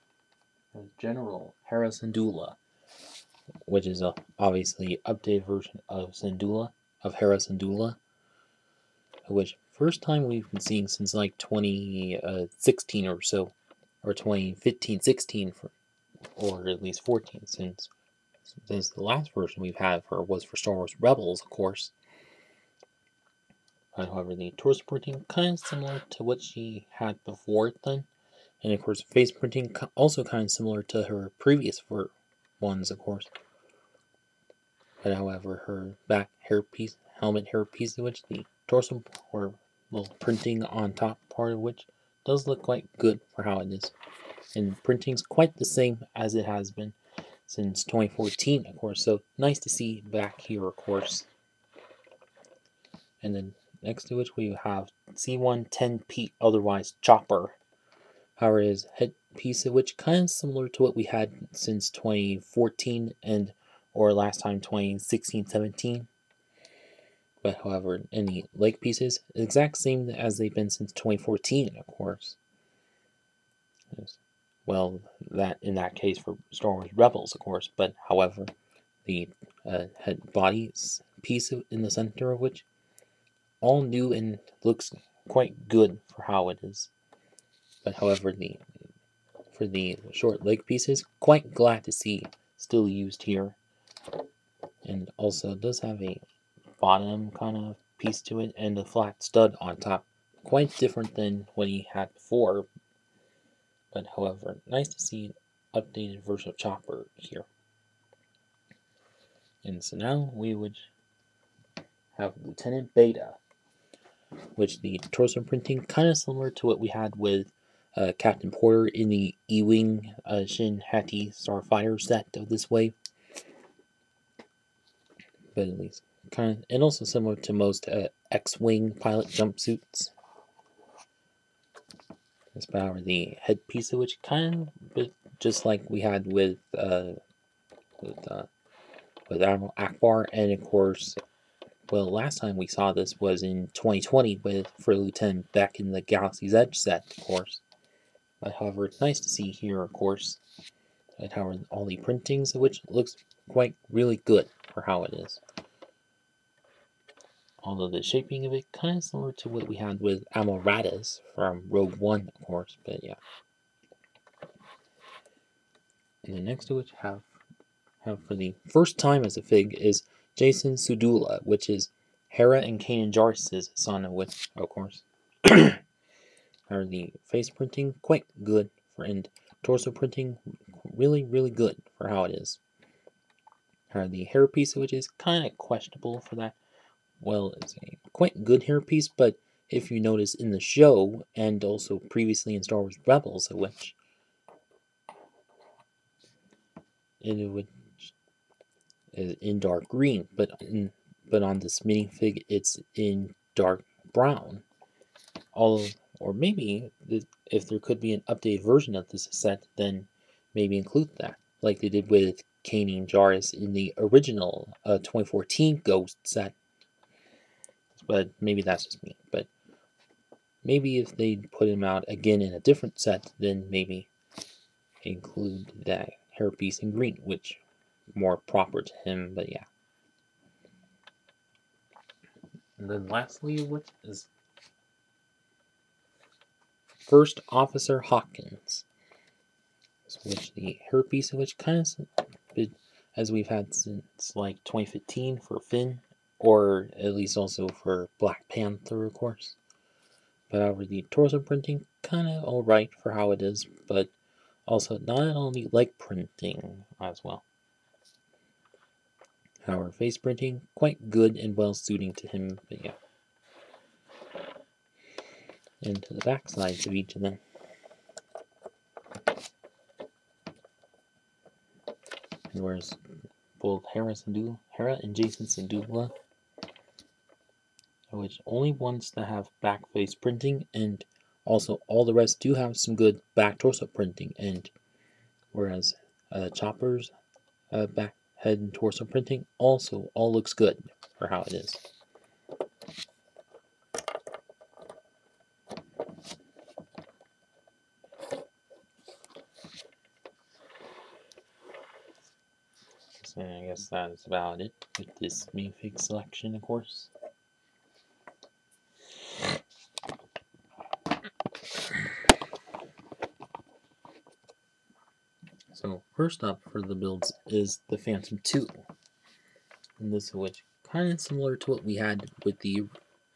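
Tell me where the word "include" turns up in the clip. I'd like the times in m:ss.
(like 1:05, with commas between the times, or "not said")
3:30, 3:45.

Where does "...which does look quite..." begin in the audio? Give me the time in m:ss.
0:41.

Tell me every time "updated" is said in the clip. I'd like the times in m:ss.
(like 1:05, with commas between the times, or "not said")
0:05, 1:45, 3:28.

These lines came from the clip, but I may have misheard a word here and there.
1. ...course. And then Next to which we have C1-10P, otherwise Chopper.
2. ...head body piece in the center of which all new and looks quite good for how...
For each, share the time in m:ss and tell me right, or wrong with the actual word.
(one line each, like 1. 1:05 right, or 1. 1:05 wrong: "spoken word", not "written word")
1. 0:50 right
2. 1:20 right.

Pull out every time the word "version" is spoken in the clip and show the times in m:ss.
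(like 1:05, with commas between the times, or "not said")
0:05, 0:19, 1:46, 3:28.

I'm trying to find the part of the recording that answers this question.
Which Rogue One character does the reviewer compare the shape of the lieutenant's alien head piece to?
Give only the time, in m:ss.
2:40.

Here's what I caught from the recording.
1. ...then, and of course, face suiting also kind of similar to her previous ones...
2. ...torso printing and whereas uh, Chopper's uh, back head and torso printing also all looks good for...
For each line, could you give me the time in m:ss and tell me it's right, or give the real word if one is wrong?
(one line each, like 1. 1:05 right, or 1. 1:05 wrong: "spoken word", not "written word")
1. 0:27 wrong: "printing", not "suiting"
2. 4:43 right.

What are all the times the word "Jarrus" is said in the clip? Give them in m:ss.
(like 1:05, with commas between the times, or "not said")
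2:53, 3:33.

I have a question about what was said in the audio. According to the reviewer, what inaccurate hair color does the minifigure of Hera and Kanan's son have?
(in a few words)
Dark brown.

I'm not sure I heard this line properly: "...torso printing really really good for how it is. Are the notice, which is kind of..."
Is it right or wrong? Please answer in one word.
wrong.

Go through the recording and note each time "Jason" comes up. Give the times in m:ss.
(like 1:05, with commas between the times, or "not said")
2:50.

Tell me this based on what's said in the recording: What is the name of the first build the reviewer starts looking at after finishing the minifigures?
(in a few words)
Phantom 2.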